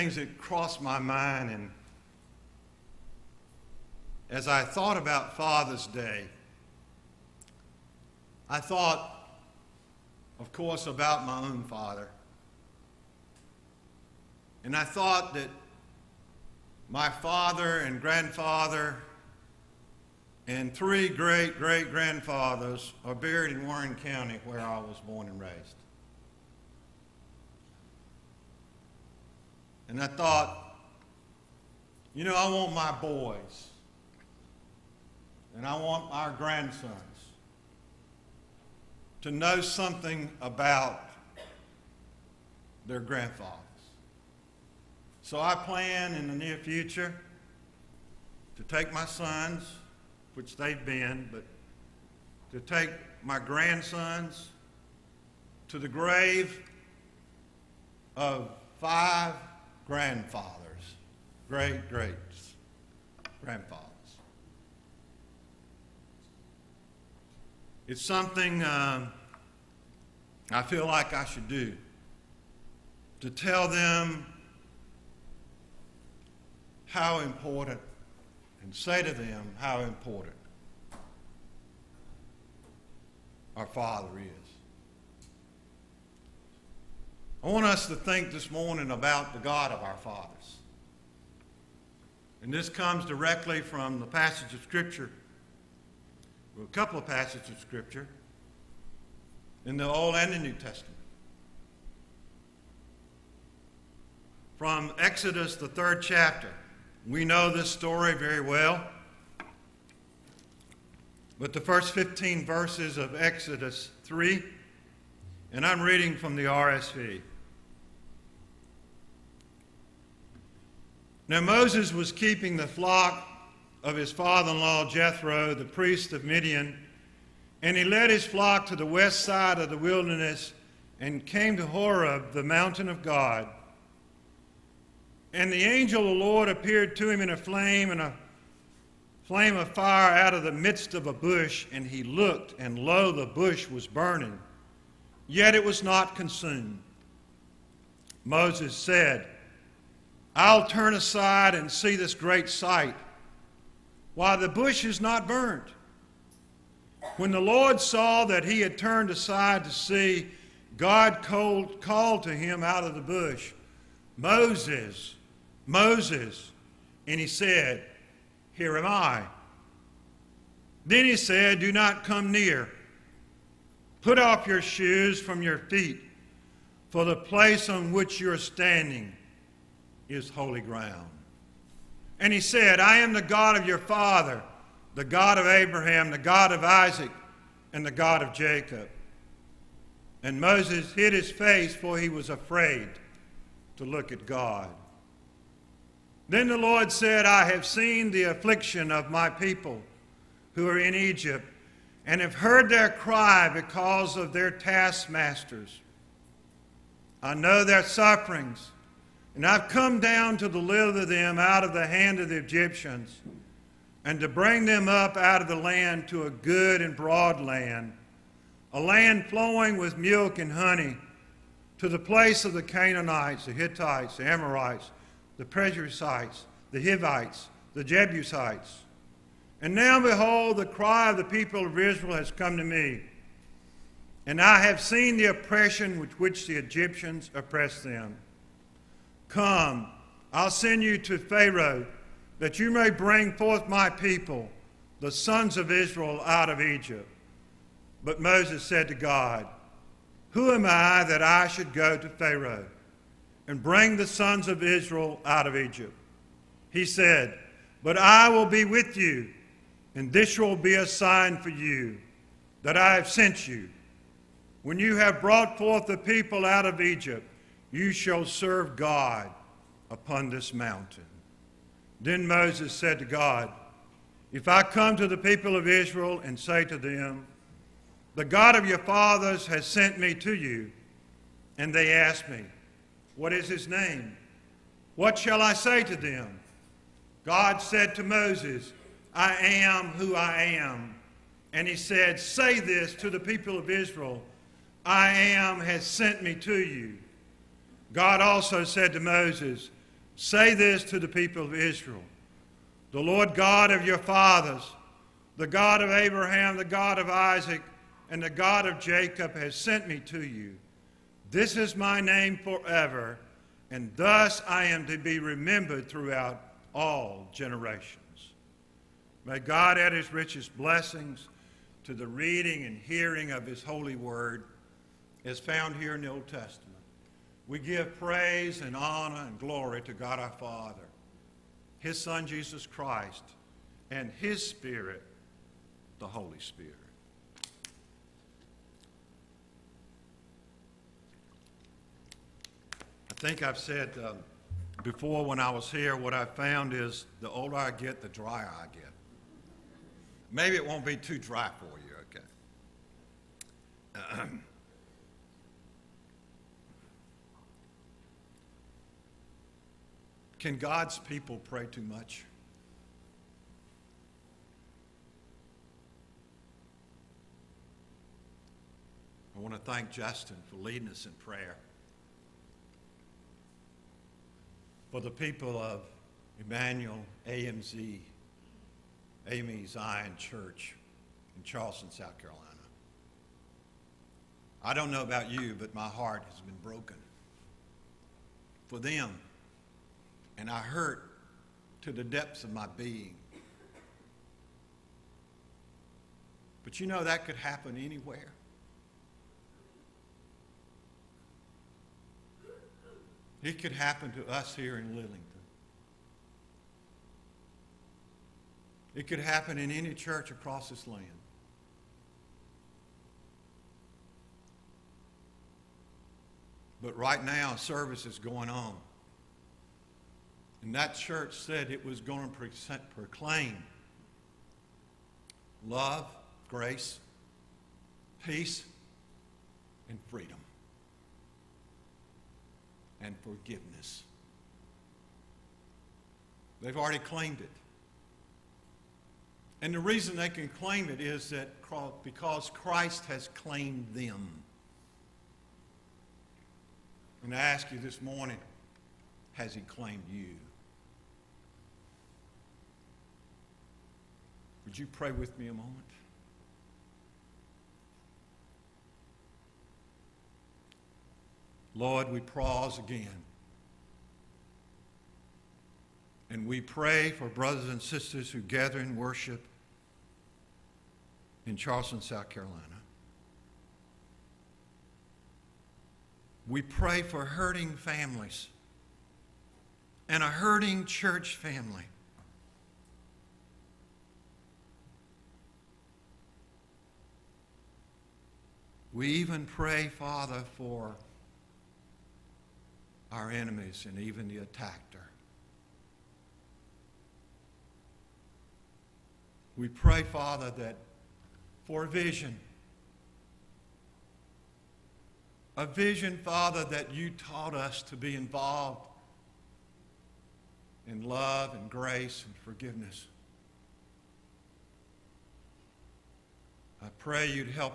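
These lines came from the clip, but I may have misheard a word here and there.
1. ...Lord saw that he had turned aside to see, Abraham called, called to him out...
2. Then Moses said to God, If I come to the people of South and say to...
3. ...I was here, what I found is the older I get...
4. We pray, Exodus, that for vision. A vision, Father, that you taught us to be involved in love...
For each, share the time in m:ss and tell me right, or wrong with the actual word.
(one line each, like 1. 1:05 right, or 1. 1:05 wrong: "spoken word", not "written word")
1. 2:37 wrong: "God", not "Abraham"
2. 4:32 wrong: "Israel", not "South"
3. 5:45 right
4. 8:19 wrong: "Father", not "Exodus".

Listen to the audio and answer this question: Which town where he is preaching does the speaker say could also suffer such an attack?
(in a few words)
Lillington.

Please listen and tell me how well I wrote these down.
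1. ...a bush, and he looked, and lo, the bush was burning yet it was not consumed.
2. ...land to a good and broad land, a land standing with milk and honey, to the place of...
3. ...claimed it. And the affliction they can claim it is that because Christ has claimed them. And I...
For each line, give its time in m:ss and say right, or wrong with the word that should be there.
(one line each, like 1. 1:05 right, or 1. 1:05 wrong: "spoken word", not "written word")
1. 2:21 right
2. 3:35 wrong: "flowing", not "standing"
3. 7:16 wrong: "reason", not "affliction".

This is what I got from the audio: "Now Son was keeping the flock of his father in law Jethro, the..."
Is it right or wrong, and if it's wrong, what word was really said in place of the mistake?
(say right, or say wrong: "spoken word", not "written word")
wrong: "Moses", not "Son".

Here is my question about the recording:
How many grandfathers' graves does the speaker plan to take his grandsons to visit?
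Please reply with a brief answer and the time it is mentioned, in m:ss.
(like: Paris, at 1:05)
5, at 0:58.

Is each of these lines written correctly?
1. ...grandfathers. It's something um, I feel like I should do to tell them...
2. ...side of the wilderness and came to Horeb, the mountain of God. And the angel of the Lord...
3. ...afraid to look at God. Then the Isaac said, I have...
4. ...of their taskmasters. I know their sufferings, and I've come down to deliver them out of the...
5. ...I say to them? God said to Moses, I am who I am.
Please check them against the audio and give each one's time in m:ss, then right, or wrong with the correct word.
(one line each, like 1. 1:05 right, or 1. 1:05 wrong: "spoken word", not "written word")
1. 1:03 right
2. 2:09 right
3. 3:12 wrong: "Lord", not "Isaac"
4. 3:24 right
5. 4:45 right.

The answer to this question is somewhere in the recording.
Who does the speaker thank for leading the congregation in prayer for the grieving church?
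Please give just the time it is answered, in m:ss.
6:09.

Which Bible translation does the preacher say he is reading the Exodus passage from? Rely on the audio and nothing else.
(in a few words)
RSV.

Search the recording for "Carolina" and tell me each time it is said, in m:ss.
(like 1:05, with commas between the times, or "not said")
6:22, 7:52.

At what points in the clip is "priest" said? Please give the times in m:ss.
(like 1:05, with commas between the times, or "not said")
2:05.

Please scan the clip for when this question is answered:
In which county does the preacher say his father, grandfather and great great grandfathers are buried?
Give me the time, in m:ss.
0:23.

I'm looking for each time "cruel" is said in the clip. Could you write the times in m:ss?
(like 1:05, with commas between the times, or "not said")
not said.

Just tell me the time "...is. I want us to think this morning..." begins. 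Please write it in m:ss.
1:24.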